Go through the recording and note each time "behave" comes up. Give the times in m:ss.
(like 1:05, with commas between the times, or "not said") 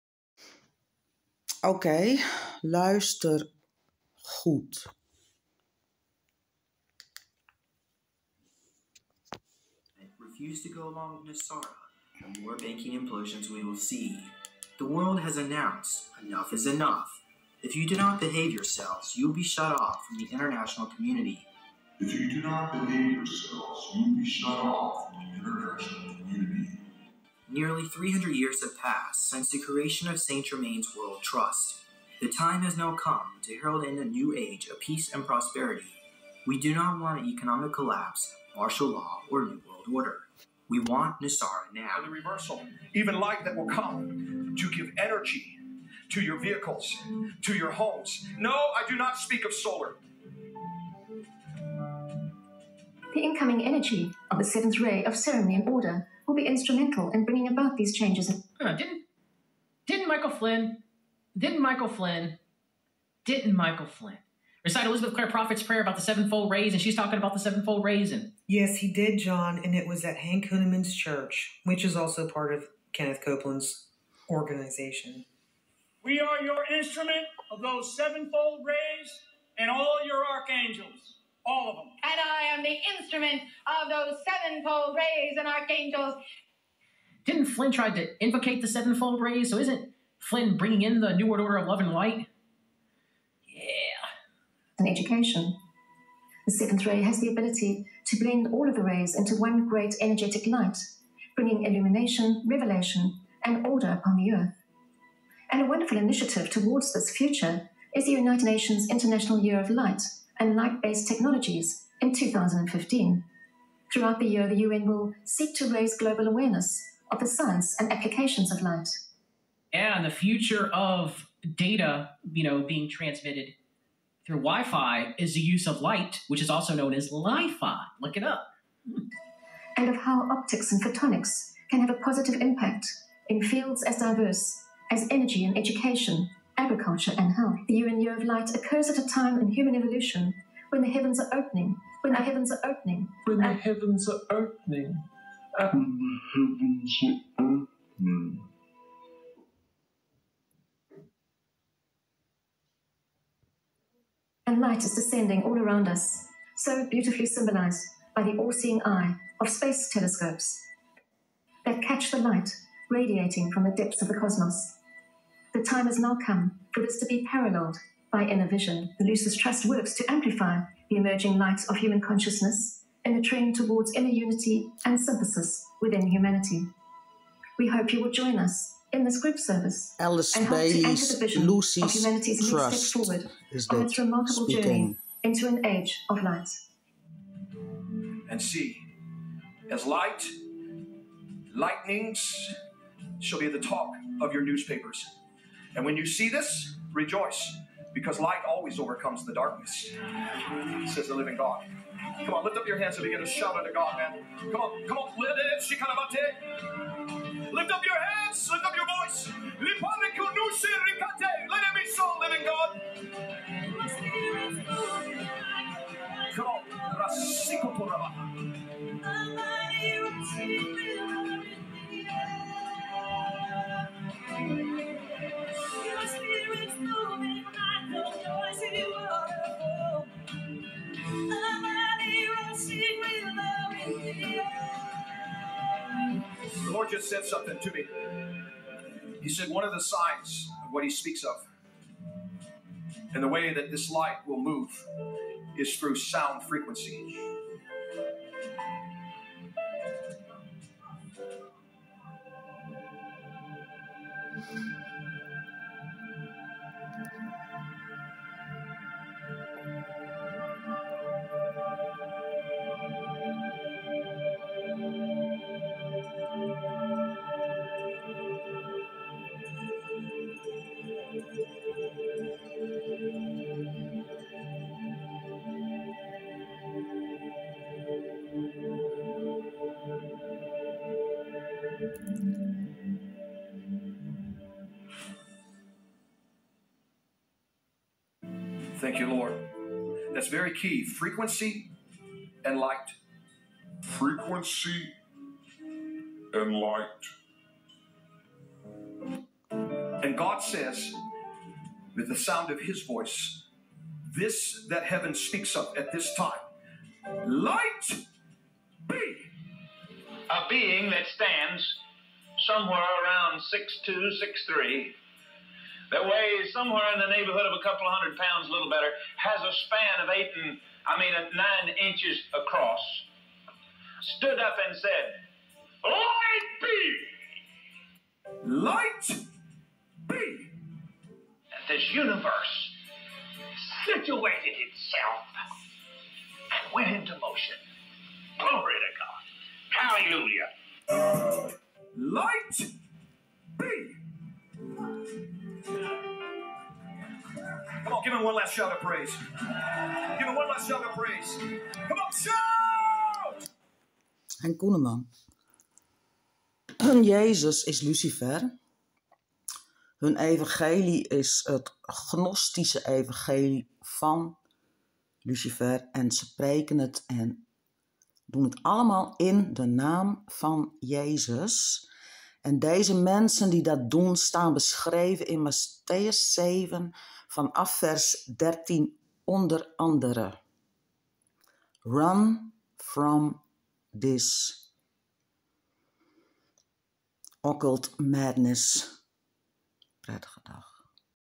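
0:18, 0:22.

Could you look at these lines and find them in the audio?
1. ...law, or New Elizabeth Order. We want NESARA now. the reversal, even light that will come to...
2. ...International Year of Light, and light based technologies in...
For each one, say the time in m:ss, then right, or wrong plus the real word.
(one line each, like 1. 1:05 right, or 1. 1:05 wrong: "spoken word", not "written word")
1. 0:38 wrong: "World", not "Elizabeth"
2. 1:48 right.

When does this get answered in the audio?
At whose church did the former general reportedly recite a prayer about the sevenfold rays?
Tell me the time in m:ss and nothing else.
1:10.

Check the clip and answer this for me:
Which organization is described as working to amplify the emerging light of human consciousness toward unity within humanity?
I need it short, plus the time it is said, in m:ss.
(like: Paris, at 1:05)
Lucis Trust, at 2:49.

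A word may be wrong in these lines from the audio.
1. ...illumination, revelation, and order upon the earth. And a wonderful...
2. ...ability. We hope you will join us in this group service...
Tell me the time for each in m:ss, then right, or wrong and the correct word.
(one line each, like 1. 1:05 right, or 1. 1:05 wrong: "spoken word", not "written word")
1. 1:41 right
2. 2:56 wrong: "humanity", not "ability".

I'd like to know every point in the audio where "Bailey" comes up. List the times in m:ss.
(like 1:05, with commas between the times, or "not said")
3:00.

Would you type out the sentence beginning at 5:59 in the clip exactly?
Hun evangelie is het gnostische evangelie van Lucifer.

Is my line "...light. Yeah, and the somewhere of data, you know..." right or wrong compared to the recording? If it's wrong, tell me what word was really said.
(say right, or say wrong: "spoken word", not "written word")
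wrong: "future", not "somewhere".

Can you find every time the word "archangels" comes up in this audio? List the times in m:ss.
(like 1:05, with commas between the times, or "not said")
1:20, 1:25.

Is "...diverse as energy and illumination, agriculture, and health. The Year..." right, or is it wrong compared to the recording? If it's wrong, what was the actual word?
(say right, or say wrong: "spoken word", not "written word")
wrong: "education", not "illumination".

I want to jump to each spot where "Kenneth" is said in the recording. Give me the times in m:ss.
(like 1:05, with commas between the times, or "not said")
1:12.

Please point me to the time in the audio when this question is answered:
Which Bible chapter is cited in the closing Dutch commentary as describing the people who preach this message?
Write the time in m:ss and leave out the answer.
6:15.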